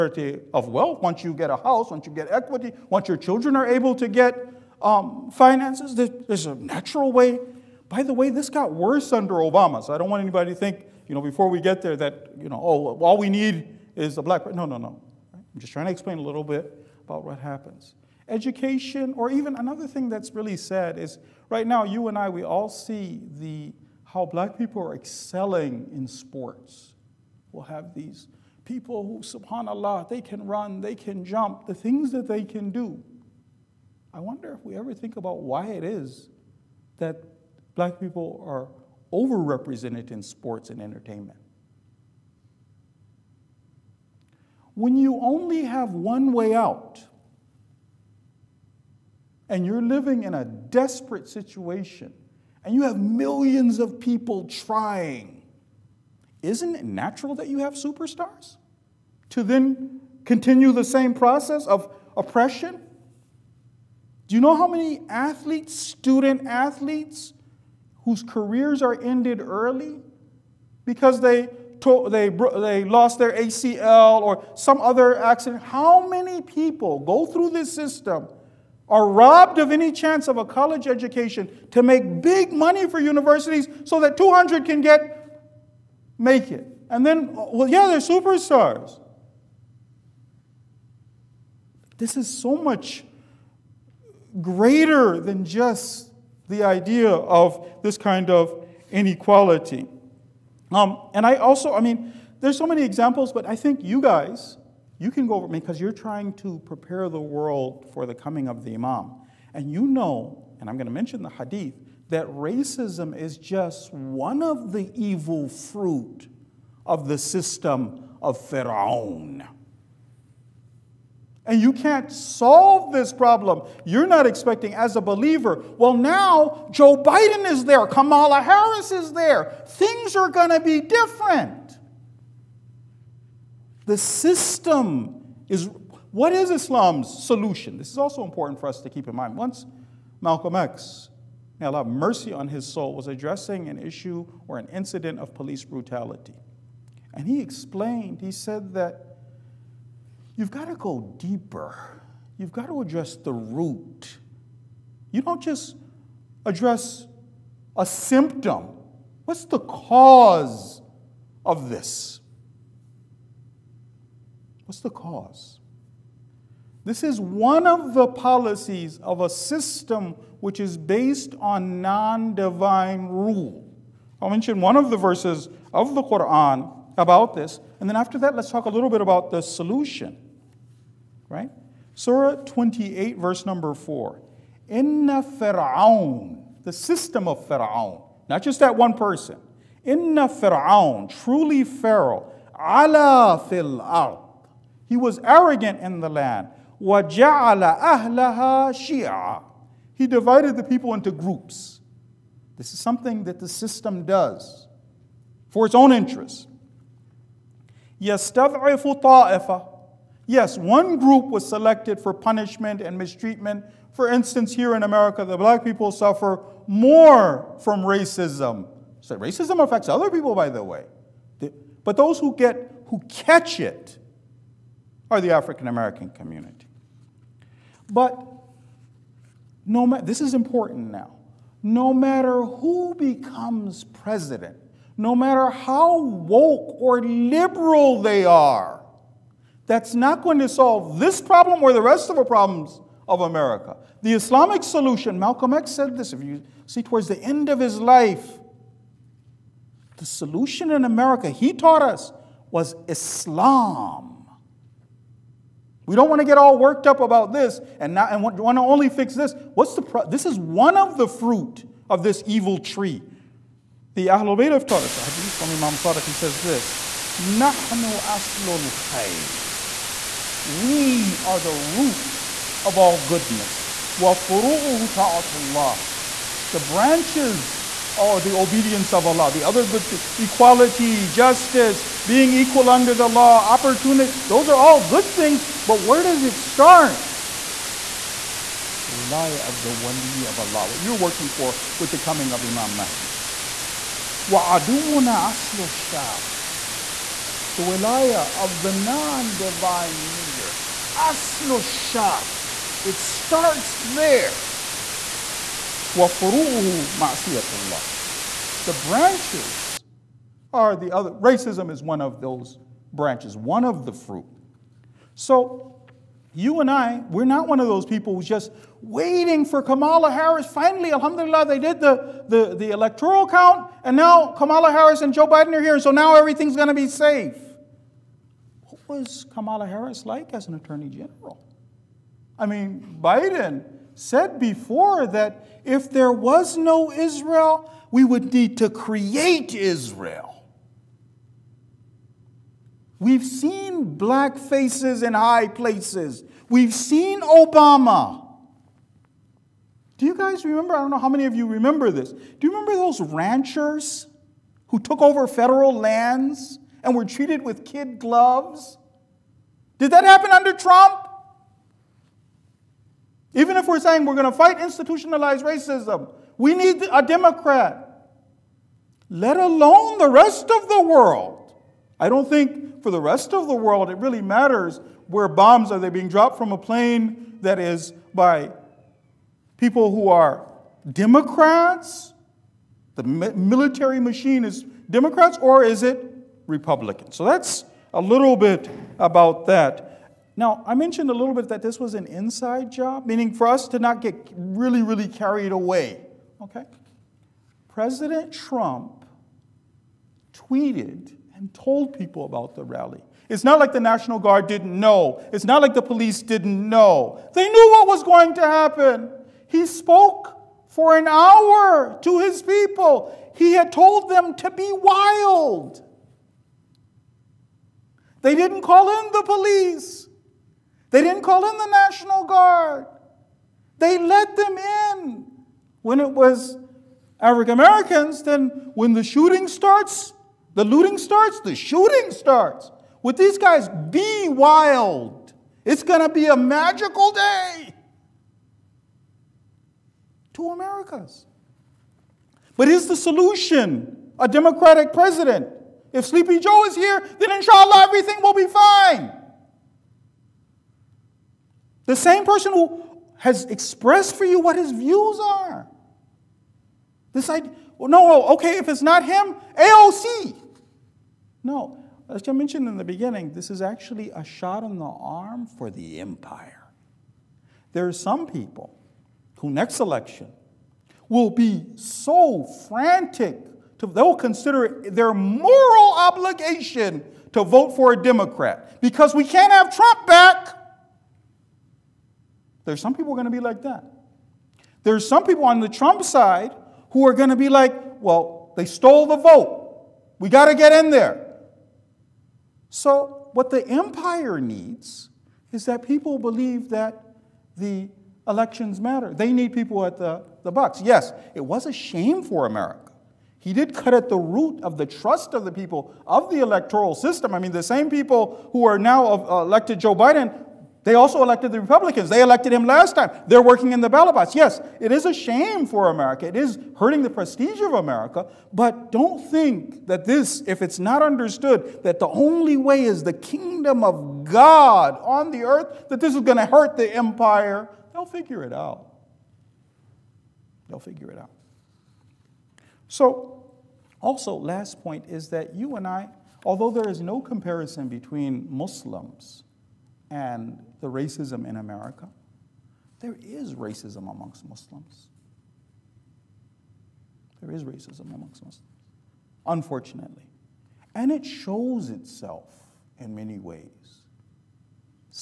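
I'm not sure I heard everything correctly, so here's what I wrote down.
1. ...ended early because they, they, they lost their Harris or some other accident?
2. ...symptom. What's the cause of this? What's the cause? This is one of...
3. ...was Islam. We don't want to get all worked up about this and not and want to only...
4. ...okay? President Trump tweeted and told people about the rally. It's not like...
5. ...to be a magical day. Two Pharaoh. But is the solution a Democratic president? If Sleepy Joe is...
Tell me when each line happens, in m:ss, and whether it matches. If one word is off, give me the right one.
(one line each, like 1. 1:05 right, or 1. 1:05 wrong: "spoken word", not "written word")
1. 1:08 wrong: "ACL", not "Harris"
2. 2:37 right
3. 4:12 right
4. 6:36 right
5. 7:15 wrong: "Americas", not "Pharaoh".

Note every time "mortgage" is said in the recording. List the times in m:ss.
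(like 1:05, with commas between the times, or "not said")
not said.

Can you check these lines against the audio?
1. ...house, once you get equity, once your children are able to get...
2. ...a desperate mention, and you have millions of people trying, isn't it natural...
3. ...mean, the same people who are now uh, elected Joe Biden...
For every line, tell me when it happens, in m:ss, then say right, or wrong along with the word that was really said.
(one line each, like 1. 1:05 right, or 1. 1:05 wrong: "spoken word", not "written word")
1. 0:01 right
2. 0:50 wrong: "situation", not "mention"
3. 8:27 right.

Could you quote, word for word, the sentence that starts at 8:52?
So, also, last point is that you and I, although there is no comparison between Muslims, and the racism in America.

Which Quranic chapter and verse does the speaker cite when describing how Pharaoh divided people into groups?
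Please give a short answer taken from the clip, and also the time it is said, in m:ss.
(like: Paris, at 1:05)
Surah 28, verse 4, at 3:02.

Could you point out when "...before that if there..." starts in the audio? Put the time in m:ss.
5:34.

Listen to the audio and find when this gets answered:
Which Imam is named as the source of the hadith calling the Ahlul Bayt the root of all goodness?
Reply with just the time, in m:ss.
4:25.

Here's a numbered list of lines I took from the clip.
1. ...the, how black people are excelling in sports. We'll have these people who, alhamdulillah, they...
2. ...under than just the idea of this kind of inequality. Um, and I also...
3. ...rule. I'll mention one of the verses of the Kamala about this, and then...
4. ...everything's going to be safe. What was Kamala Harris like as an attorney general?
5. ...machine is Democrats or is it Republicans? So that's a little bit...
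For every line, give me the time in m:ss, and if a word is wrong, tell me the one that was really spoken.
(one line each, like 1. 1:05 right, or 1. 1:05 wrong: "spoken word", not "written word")
1. 0:23 wrong: "subhanAllah", not "alhamdulillah"
2. 1:34 wrong: "greater", not "under"
3. 2:53 wrong: "Quran", not "Kamala"
4. 5:26 right
5. 6:23 right.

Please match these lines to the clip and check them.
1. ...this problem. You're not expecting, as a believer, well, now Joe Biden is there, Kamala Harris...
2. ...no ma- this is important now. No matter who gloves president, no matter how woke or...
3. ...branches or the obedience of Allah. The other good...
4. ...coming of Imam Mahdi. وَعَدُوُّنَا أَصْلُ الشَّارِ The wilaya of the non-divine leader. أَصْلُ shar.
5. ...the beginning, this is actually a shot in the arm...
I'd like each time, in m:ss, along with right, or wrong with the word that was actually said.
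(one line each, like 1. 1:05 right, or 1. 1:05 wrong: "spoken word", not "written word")
1. 2:02 right
2. 3:49 wrong: "becomes", not "gloves"
3. 4:36 right
4. 4:51 right
5. 7:42 right.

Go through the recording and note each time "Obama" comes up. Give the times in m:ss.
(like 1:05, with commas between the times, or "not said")
0:09, 5:47.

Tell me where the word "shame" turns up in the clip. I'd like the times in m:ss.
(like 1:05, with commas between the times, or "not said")
8:21, 8:35.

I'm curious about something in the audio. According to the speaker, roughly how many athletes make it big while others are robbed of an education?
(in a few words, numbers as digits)
200.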